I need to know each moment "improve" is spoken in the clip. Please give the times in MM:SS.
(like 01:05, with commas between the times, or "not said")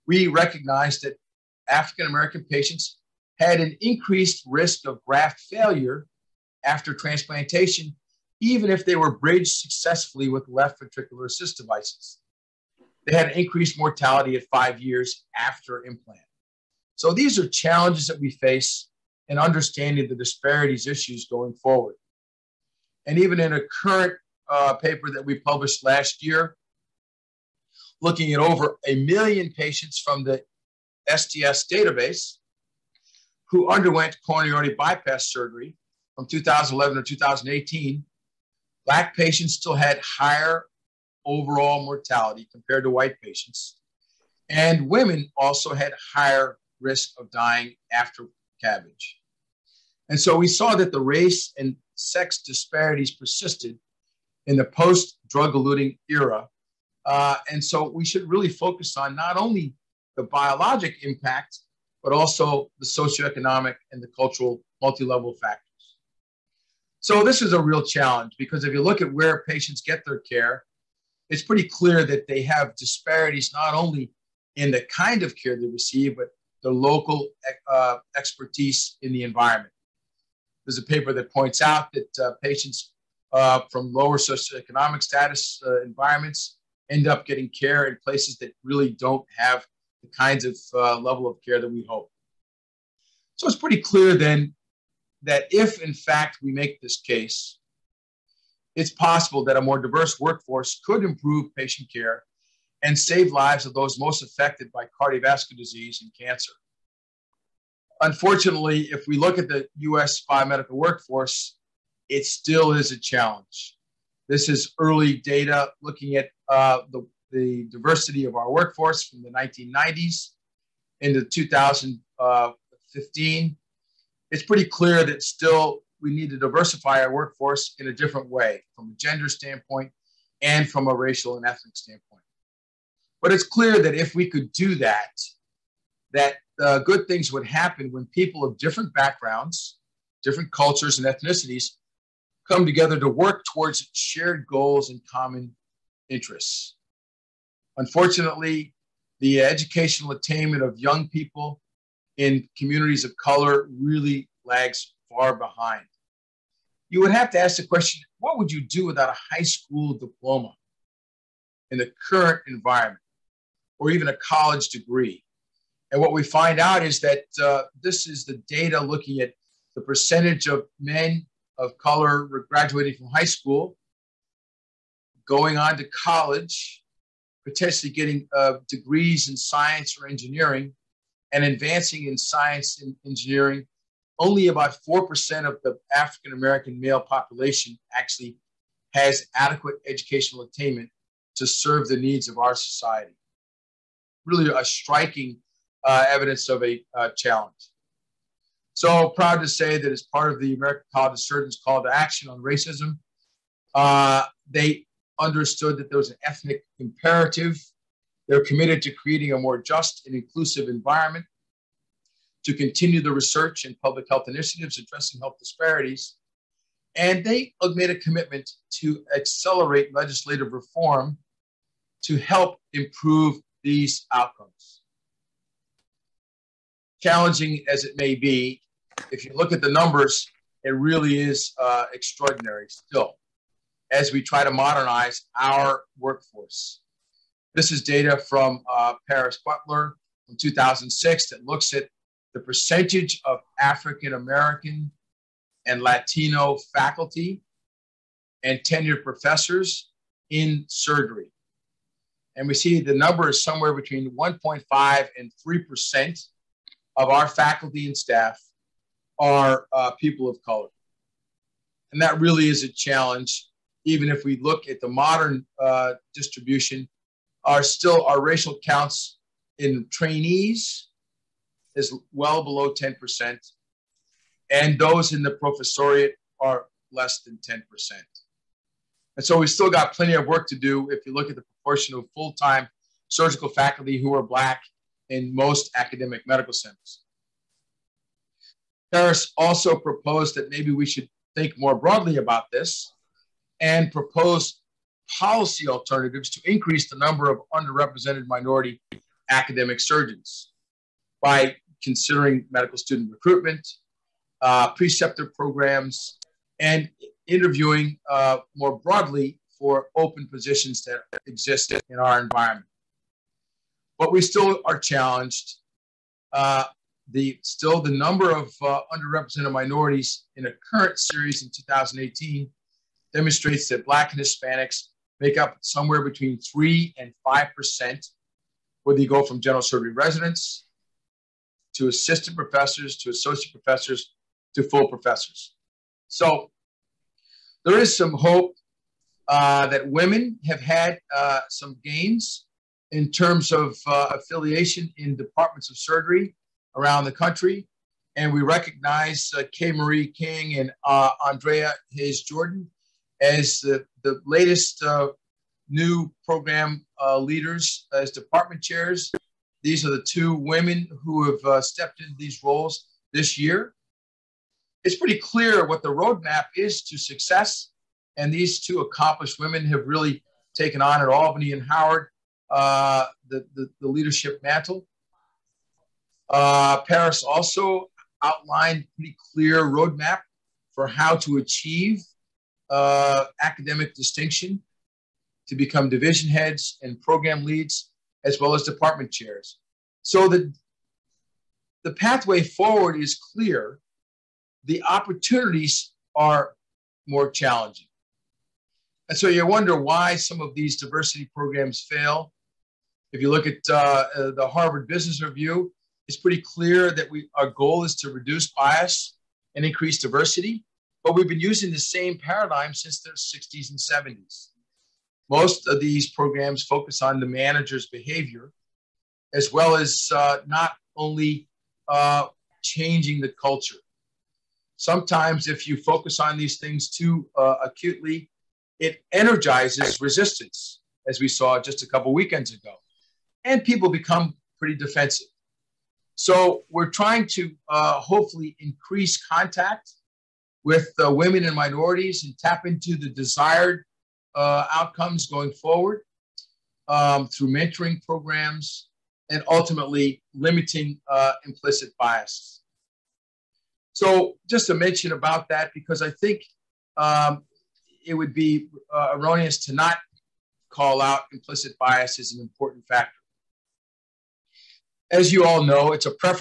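01:41, 03:42.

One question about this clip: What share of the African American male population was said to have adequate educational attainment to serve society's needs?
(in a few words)
4%.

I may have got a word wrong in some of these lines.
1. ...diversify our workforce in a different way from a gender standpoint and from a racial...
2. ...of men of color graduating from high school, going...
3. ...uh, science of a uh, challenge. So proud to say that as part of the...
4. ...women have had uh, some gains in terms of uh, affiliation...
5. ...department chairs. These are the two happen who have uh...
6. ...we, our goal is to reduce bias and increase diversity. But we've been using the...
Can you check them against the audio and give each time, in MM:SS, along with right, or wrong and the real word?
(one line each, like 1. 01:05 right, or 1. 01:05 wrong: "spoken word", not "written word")
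1. 02:06 right
2. 02:50 right
3. 03:15 wrong: "evidence", not "science"
4. 05:39 right
5. 05:58 wrong: "women", not "happen"
6. 06:47 right.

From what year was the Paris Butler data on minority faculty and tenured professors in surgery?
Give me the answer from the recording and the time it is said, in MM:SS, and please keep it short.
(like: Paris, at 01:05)
2006, at 04:00.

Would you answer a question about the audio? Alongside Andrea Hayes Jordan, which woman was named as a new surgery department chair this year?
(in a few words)
Kay Marie King.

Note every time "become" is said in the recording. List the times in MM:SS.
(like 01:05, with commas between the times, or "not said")
06:25, 07:13.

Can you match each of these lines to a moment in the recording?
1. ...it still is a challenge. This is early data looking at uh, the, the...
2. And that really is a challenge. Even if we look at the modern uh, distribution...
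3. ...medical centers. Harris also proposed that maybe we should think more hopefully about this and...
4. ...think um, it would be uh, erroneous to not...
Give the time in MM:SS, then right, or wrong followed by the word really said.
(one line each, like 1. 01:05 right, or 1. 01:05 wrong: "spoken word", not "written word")
1. 01:52 right
2. 04:21 right
3. 04:46 wrong: "broadly", not "hopefully"
4. 07:36 right.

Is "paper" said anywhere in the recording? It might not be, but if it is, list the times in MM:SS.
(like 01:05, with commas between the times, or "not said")
00:24, 01:20.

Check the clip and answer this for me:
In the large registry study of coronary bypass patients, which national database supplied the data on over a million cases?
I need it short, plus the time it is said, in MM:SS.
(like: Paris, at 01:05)
STS database, at 00:30.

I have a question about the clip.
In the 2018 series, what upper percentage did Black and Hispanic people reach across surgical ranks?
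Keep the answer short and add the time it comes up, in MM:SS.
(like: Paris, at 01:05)
5 percent, at 05:27.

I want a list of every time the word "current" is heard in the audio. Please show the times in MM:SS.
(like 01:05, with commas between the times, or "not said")
00:23, 02:42, 05:20.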